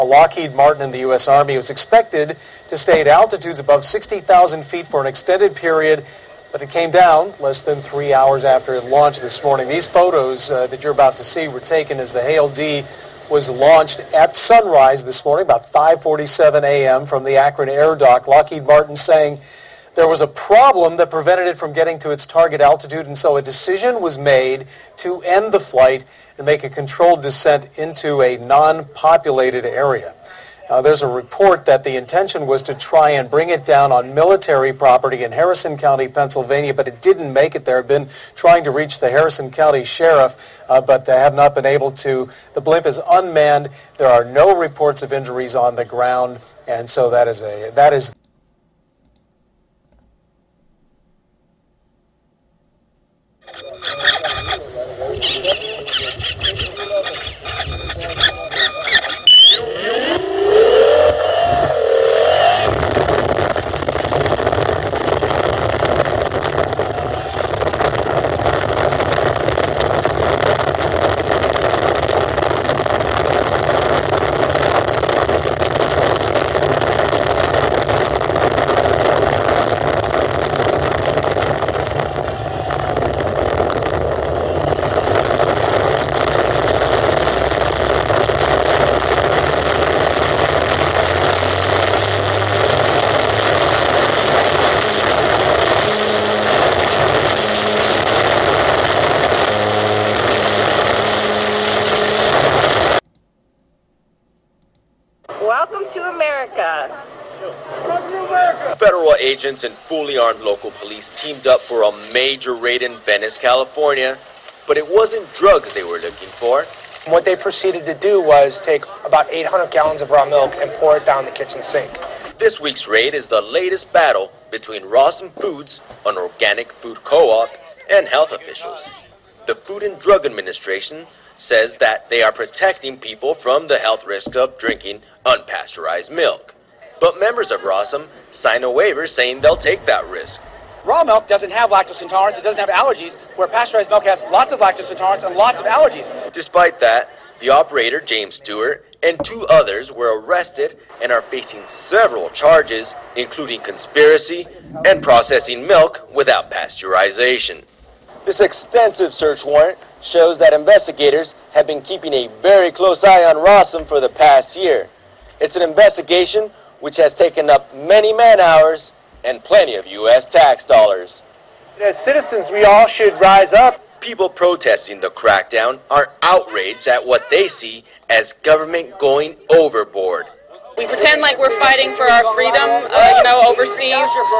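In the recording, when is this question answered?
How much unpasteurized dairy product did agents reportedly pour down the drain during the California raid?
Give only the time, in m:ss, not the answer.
1:59.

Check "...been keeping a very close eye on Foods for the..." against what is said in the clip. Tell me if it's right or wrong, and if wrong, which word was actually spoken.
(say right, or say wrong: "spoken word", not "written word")
wrong: "Rawesome", not "Foods".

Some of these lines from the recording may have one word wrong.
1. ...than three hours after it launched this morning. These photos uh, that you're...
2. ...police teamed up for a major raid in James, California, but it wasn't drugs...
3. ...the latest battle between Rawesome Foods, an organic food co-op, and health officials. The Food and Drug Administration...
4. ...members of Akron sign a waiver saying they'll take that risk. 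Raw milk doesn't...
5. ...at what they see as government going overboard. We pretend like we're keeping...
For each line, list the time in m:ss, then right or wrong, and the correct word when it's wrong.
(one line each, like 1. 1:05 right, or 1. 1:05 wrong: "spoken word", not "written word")
1. 0:07 right
2. 1:50 wrong: "Venice", not "James"
3. 2:03 right
4. 2:17 wrong: "Rawesome", not "Akron"
5. 2:56 wrong: "fighting", not "keeping".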